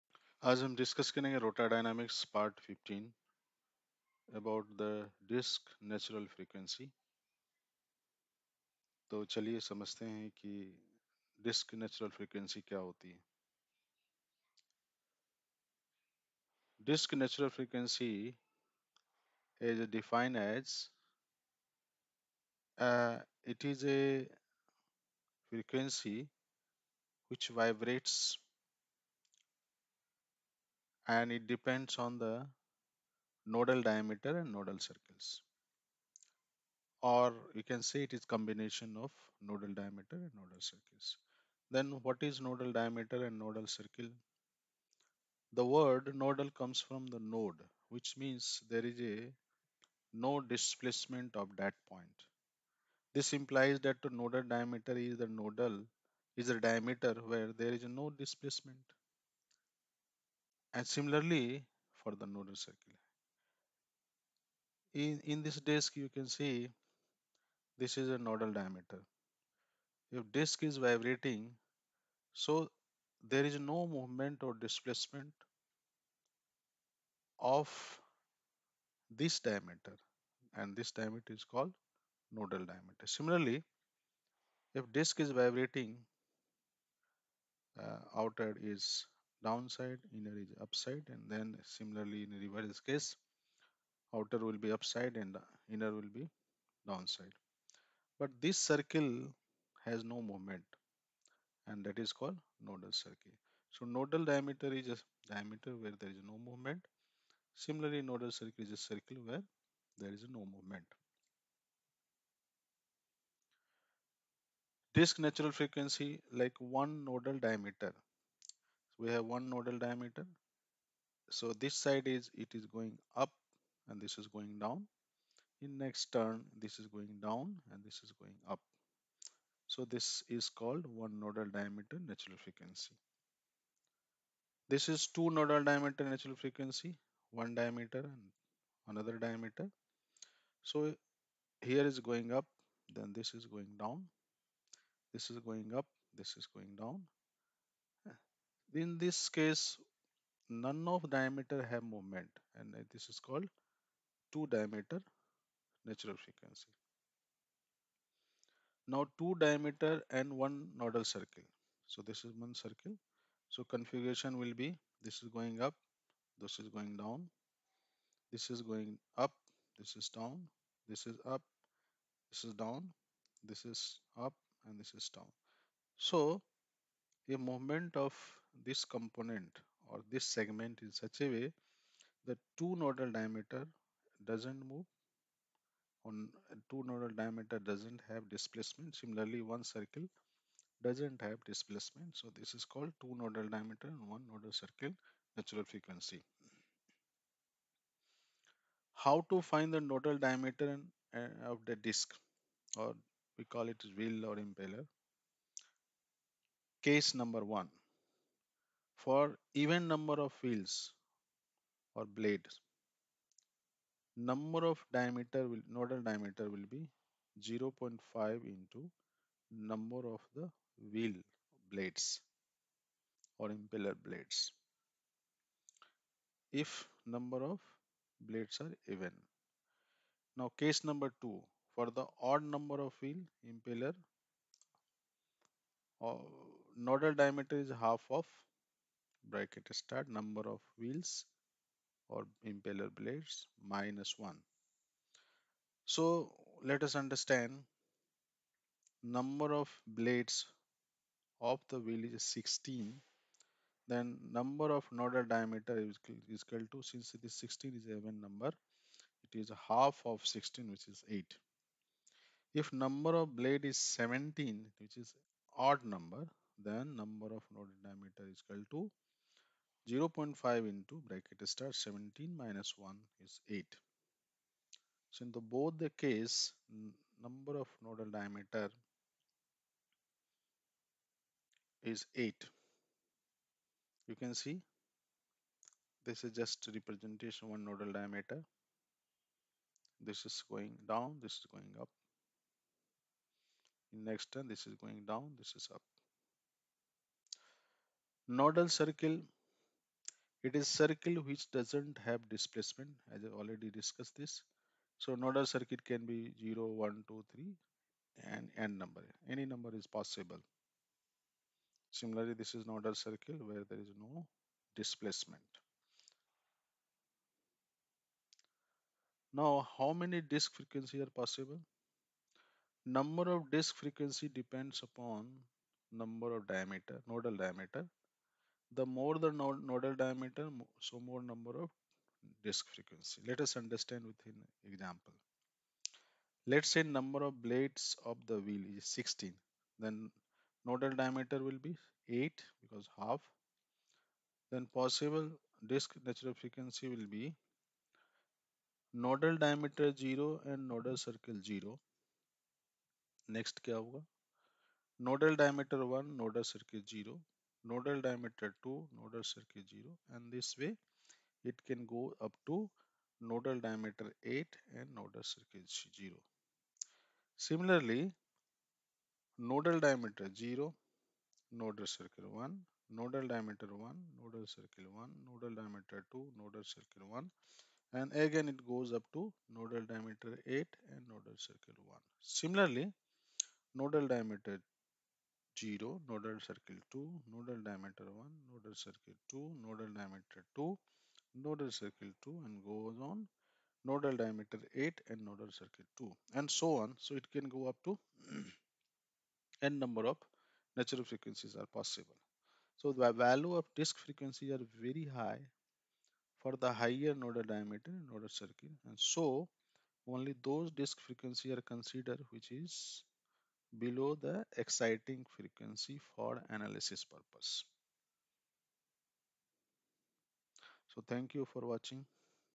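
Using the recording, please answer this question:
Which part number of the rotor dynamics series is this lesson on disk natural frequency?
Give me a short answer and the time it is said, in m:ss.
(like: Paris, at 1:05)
Part 15, at 0:02.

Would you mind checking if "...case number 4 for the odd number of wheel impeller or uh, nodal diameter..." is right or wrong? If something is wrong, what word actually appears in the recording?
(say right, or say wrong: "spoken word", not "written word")
wrong: "2", not "4".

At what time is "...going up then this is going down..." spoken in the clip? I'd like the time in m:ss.
2:22.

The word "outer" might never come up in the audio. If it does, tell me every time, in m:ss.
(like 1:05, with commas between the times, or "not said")
1:28, 1:34.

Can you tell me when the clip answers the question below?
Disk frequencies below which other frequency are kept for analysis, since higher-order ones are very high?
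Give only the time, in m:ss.
6:54.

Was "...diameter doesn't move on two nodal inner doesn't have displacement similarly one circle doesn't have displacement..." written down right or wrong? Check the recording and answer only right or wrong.
wrong.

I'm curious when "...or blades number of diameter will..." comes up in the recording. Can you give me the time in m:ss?
3:31.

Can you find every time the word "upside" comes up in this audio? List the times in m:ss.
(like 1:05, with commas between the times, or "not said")
1:30, 1:34.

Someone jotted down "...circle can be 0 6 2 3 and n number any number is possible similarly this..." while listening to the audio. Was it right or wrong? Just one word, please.
wrong.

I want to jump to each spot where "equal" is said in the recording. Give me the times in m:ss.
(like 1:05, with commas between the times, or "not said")
4:16, 4:28.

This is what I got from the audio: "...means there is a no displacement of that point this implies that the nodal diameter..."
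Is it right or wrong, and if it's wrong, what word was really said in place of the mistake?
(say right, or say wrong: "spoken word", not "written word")
right.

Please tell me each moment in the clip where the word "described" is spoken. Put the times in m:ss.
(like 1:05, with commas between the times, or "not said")
not said.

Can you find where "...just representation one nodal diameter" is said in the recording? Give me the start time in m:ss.
4:46.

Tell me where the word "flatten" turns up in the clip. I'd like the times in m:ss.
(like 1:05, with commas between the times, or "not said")
not said.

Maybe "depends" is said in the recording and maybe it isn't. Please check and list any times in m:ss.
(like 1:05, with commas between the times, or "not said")
0:31, 5:24.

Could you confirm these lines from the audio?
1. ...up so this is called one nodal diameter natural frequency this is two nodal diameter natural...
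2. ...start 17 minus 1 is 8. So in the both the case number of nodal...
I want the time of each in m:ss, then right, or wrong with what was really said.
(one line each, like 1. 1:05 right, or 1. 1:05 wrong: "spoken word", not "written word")
1. 2:08 right
2. 4:31 right.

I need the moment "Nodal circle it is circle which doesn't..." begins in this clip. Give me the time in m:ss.
4:58.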